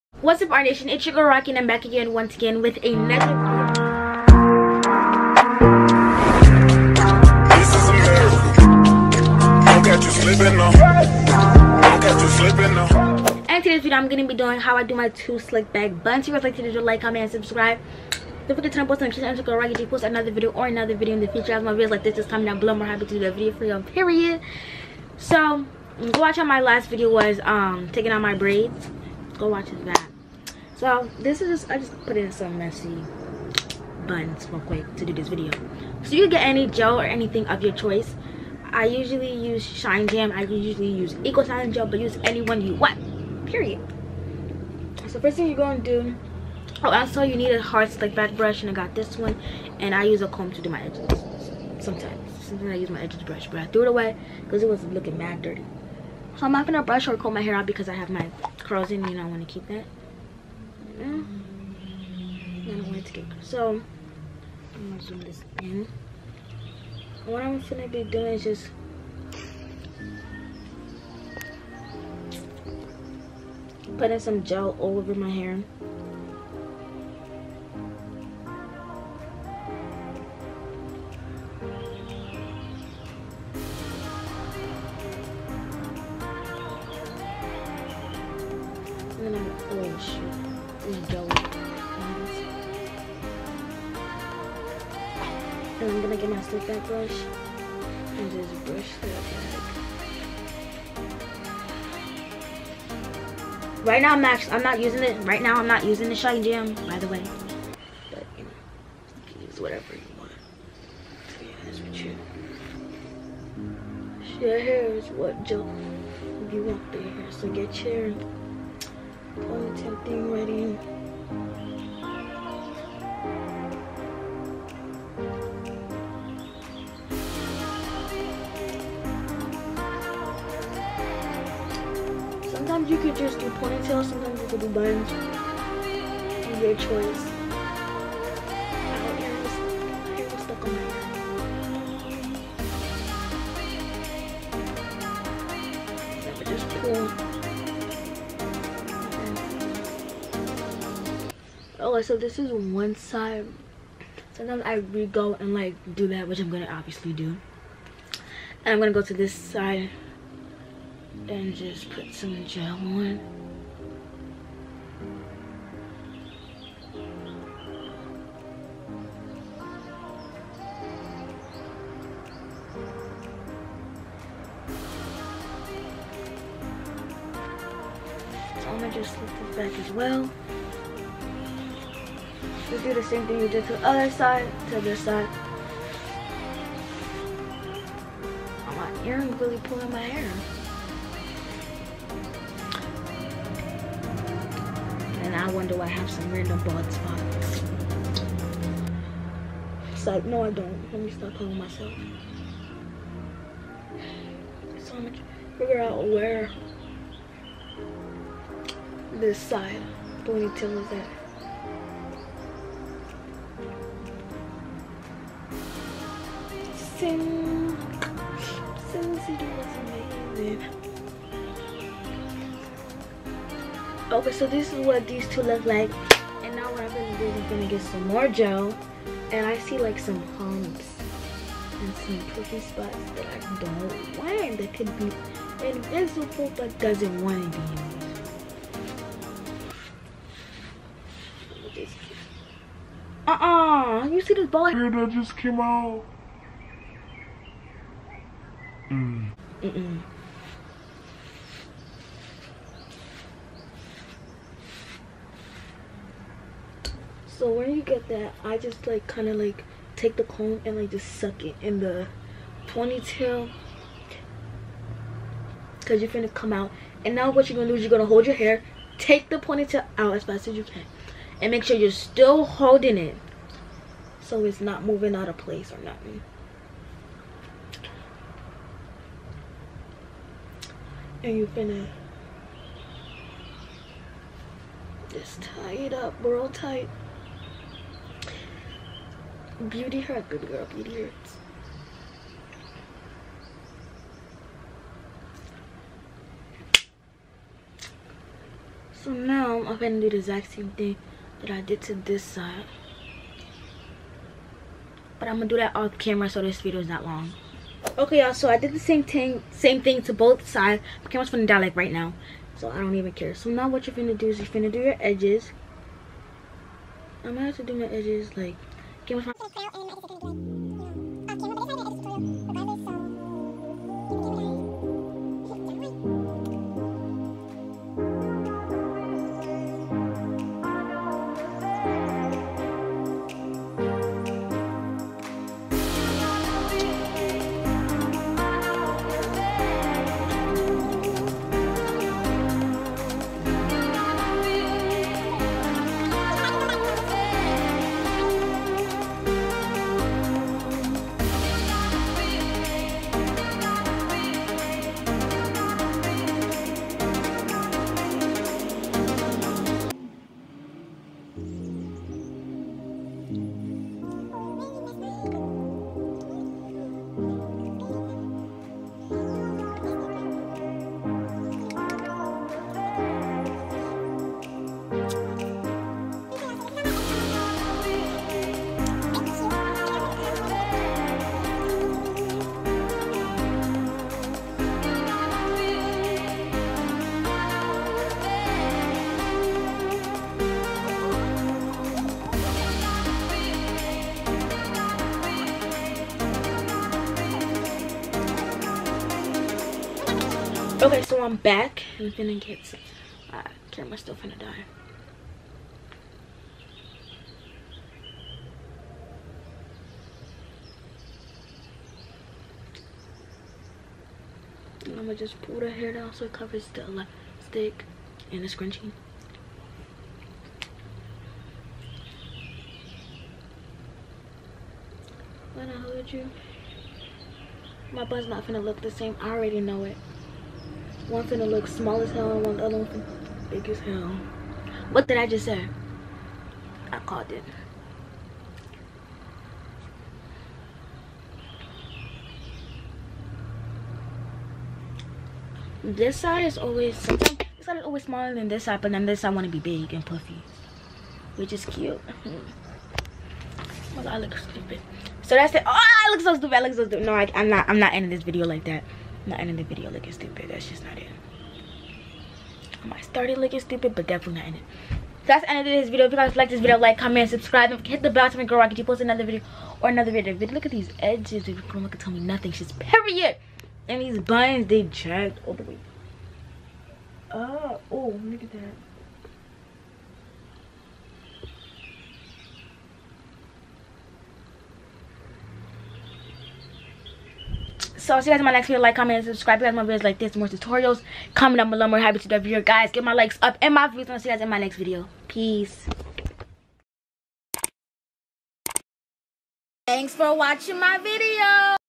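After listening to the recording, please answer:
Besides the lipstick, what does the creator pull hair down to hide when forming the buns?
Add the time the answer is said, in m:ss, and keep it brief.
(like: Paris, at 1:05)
Scrunchie, at 6:58.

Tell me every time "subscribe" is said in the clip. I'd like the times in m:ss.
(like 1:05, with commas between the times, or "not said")
0:17, 7:47, 8:09.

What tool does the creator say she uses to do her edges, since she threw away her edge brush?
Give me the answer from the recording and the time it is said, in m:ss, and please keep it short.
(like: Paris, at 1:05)
A comb, at 0:50.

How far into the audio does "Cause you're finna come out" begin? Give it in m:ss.
4:25.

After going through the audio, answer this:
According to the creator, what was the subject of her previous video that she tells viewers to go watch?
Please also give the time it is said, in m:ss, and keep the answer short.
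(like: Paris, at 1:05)
Taking out my braids, at 0:27.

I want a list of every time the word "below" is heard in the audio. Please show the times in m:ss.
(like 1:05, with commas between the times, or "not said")
0:22, 8:11.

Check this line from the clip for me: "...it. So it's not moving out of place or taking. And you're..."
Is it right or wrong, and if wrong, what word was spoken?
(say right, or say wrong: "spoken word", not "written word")
wrong: "nothing", not "taking".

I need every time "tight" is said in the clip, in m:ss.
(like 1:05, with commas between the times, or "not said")
4:46.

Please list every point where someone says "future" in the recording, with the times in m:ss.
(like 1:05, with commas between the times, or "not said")
0:21.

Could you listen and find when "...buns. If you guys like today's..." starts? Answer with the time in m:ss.
0:16.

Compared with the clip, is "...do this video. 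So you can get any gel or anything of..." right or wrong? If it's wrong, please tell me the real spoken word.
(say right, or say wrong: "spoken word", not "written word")
right.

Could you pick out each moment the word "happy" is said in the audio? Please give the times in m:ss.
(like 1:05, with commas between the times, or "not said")
0:22, 8:11.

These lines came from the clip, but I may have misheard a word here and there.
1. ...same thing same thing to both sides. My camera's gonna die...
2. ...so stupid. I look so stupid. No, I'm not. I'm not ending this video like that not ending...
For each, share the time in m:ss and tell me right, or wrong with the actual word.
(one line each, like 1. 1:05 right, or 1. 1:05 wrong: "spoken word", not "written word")
1. 5:08 right
2. 7:36 right.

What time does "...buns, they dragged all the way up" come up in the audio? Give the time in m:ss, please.
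7:54.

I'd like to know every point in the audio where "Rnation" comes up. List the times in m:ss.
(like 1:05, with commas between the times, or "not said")
0:00.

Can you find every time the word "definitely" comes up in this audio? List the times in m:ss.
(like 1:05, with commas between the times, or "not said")
7:44.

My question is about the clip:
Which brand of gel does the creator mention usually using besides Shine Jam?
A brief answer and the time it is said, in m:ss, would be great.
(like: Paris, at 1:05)
Eco Sign Gel, at 0:41.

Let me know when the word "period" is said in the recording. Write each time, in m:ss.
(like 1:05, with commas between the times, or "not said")
0:23, 0:43, 7:52.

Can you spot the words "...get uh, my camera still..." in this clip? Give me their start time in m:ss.
6:42.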